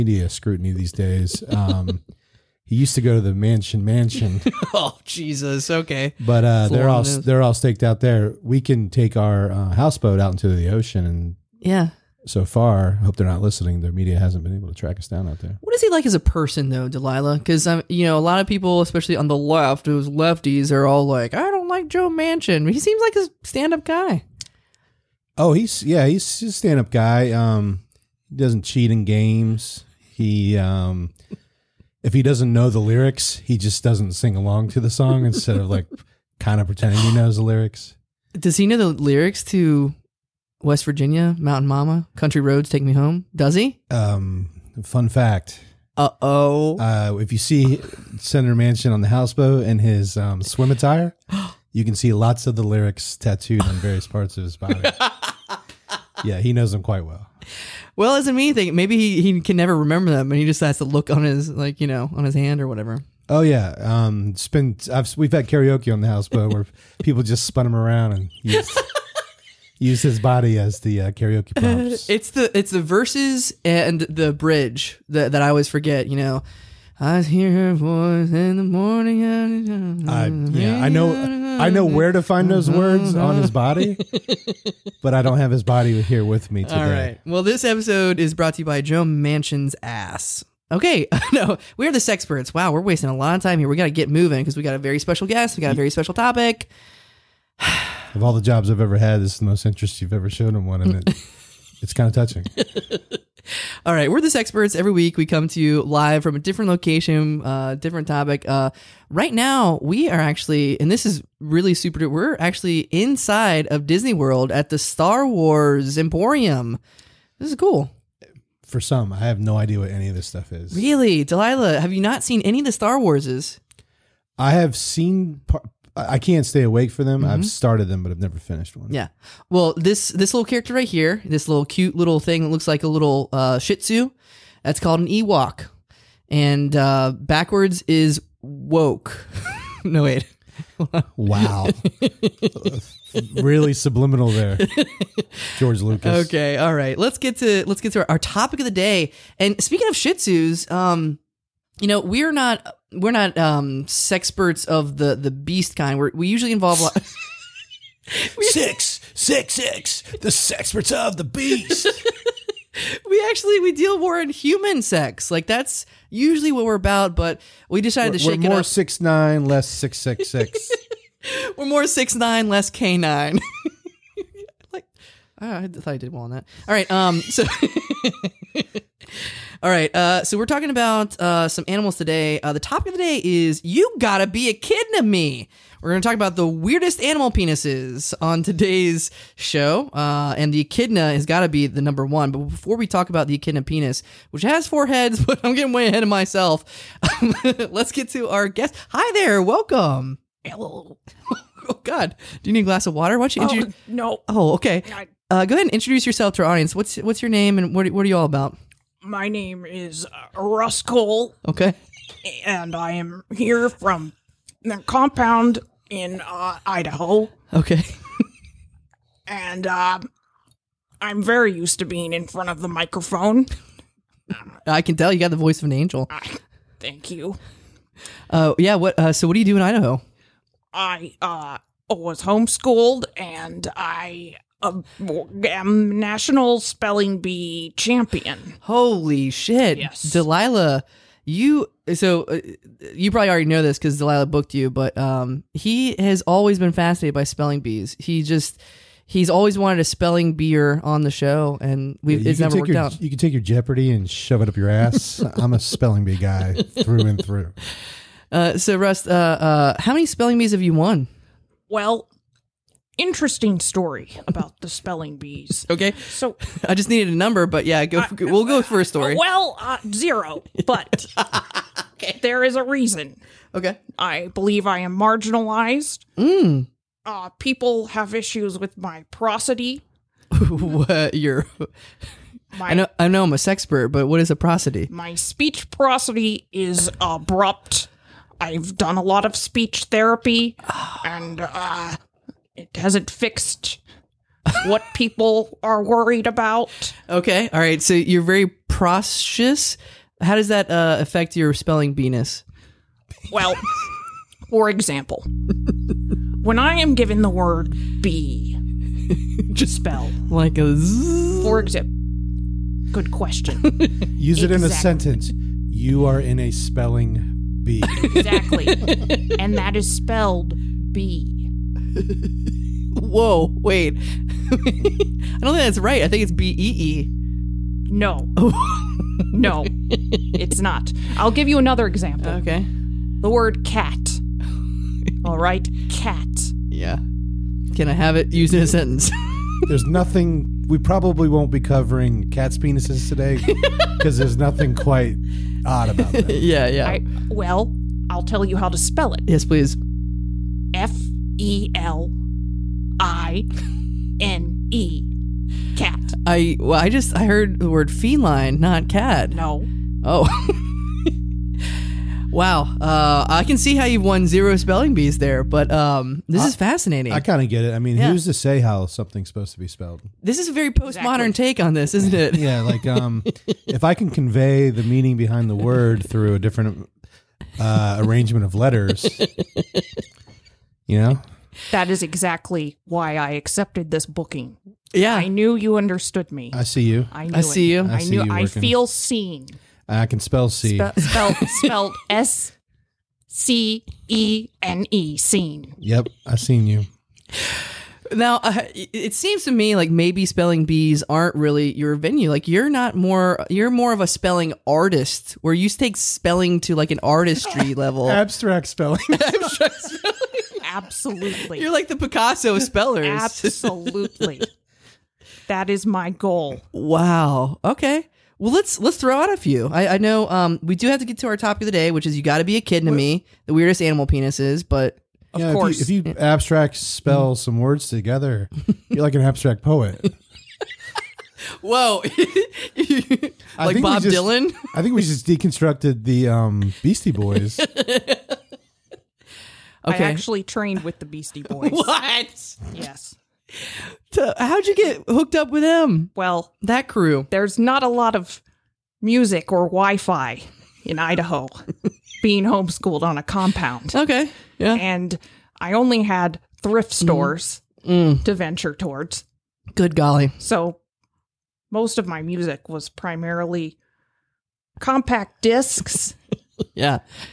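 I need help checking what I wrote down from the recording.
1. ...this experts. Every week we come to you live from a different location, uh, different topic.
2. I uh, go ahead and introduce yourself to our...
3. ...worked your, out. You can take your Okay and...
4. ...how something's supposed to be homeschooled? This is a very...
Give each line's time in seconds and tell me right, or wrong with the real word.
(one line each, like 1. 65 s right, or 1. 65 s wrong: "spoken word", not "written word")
1. 104 s right
2. 204 s right
3. 252 s wrong: "Jeopardy", not "Okay"
4. 368 s wrong: "spelled", not "homeschooled".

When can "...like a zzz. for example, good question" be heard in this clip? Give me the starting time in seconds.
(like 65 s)
310 s.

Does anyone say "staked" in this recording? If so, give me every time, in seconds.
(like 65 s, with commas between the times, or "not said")
7 s.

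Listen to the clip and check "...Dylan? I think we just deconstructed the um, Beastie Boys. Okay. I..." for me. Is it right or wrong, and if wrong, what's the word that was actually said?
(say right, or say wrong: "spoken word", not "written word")
right.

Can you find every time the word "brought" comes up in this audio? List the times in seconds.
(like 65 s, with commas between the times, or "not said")
88 s.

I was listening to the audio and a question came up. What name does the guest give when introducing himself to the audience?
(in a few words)
Rust Cohle.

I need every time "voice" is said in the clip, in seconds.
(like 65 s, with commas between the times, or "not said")
77 s, 225 s.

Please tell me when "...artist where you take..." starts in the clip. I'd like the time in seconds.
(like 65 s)
404 s.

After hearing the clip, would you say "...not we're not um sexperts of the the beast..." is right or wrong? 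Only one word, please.
right.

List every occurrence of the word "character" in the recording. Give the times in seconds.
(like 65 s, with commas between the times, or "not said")
130 s.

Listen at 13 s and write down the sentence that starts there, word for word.
Their media hasn't been able to track us down out there.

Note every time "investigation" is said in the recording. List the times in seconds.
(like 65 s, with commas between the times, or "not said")
not said.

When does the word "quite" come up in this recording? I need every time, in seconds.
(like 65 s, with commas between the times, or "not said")
56 s, 344 s.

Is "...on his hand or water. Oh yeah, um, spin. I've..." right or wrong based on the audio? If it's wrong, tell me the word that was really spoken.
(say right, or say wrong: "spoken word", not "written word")
wrong: "whatever", not "water".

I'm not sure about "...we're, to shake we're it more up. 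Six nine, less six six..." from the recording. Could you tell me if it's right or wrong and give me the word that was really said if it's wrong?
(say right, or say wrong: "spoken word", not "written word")
right.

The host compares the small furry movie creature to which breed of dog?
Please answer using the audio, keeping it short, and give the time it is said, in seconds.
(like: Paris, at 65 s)
Shih Tzu, at 133 s.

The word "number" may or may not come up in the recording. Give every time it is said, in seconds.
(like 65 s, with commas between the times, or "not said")
191 s, 267 s.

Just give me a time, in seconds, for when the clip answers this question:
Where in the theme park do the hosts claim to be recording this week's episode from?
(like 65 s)
114 s.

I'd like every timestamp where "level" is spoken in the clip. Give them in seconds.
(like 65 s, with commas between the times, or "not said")
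407 s.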